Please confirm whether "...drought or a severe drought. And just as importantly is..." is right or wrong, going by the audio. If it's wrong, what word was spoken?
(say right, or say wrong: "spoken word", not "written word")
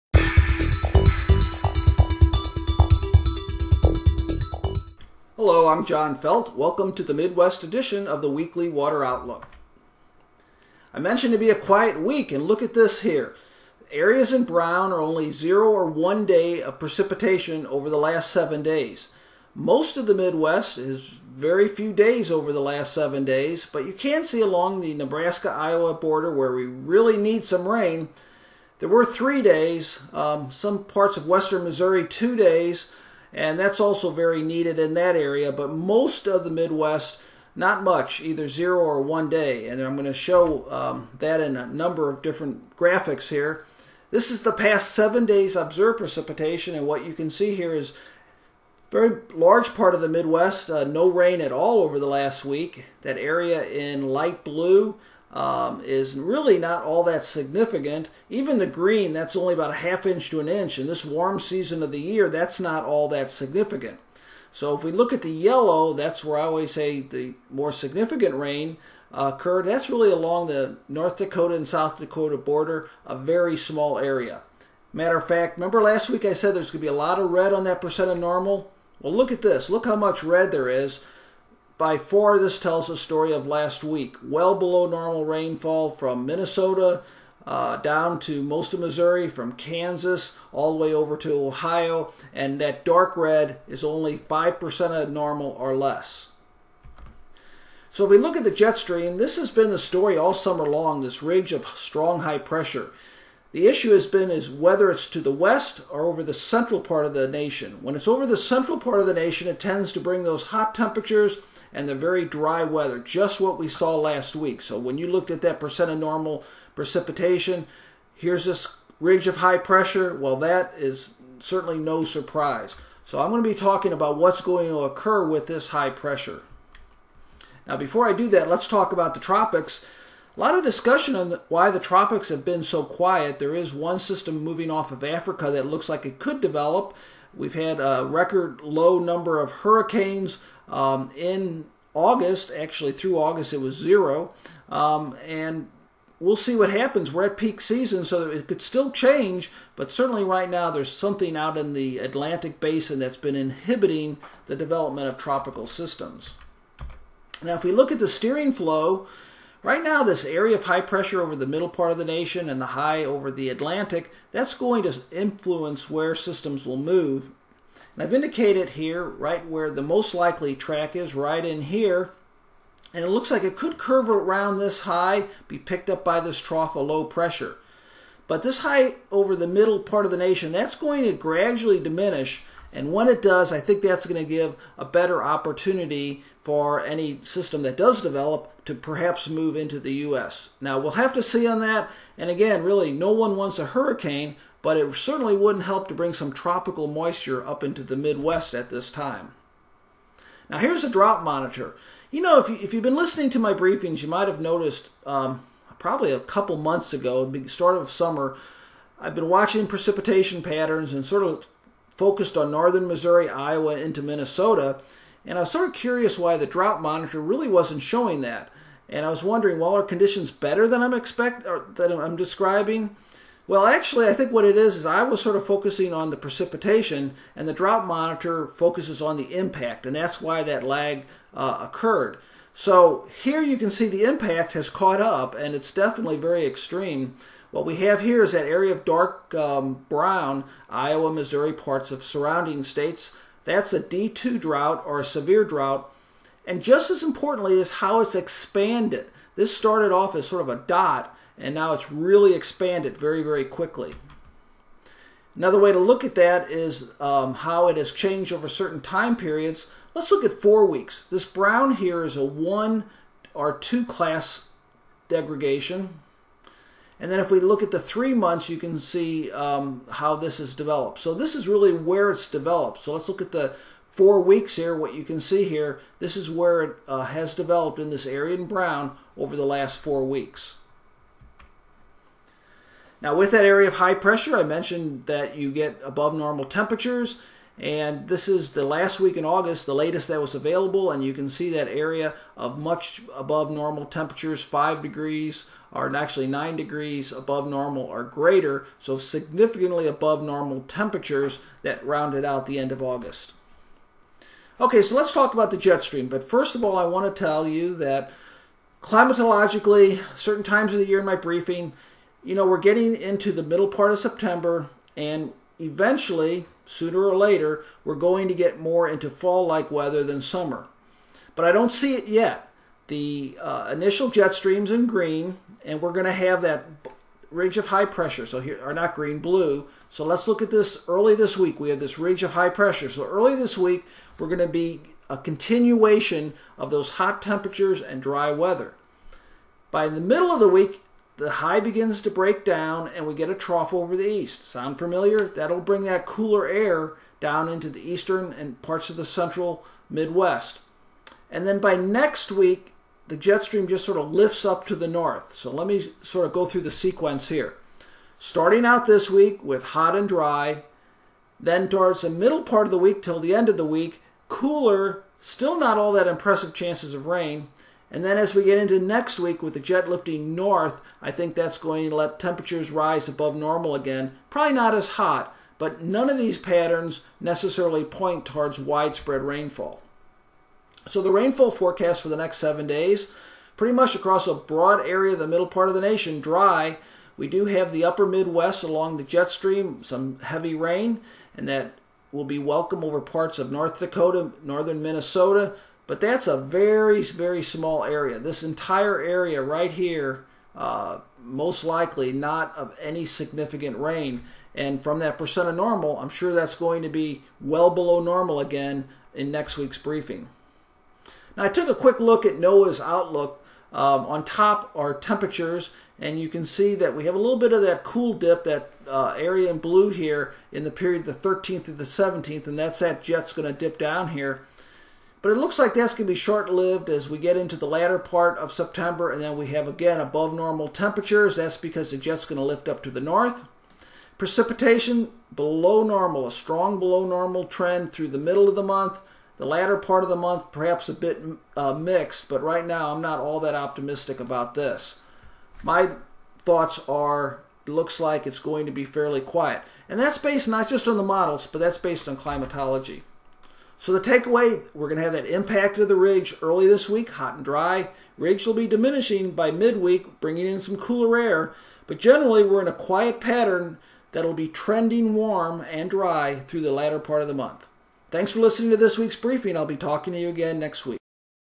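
right.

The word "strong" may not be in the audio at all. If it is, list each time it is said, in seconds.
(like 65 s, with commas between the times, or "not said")
101 s, 436 s.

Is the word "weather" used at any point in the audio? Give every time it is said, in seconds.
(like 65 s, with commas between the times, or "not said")
112 s, 319 s, 338 s.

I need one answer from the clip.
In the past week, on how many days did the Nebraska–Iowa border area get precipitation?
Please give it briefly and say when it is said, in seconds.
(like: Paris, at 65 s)
3, at 29 s.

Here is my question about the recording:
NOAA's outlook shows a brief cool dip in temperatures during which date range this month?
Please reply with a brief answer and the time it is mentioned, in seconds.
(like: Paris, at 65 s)
13th to 17th, at 421 s.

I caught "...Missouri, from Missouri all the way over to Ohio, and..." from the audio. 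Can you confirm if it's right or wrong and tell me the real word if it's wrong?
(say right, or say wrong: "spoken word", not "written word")
wrong: "Kansas", not "Missouri".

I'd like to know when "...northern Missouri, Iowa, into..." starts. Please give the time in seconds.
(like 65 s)
212 s.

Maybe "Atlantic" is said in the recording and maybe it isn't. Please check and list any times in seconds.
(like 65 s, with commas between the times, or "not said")
151 s, 163 s.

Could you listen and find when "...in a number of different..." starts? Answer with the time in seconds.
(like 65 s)
41 s.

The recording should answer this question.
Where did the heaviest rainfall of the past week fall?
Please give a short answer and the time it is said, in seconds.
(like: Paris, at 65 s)
North Dakota and South Dakota border, at 70 s.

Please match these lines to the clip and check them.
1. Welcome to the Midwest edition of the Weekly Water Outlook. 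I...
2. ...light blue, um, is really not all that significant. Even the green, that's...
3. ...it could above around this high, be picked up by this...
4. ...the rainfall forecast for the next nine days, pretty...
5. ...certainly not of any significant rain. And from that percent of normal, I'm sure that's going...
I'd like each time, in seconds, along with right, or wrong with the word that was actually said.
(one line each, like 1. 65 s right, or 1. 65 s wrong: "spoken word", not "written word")
1. 6 s right
2. 54 s right
3. 173 s wrong: "curve", not "above"
4. 381 s wrong: "seven", not "nine"
5. 401 s wrong: "likely", not "certainly".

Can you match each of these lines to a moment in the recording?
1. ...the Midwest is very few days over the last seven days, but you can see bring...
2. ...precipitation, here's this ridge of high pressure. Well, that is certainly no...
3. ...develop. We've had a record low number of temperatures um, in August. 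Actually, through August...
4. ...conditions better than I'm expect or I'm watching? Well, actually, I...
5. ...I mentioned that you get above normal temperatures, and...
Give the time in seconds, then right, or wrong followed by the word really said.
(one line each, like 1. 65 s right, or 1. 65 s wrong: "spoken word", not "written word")
1. 20 s wrong: "along", not "bring"
2. 116 s right
3. 136 s wrong: "hurricanes", not "temperatures"
4. 219 s wrong: "describing", not "watching"
5. 284 s right.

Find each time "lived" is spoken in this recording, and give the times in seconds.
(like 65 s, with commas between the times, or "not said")
426 s.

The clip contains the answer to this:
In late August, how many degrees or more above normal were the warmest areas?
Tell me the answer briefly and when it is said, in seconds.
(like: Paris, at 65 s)
9 degrees, at 296 s.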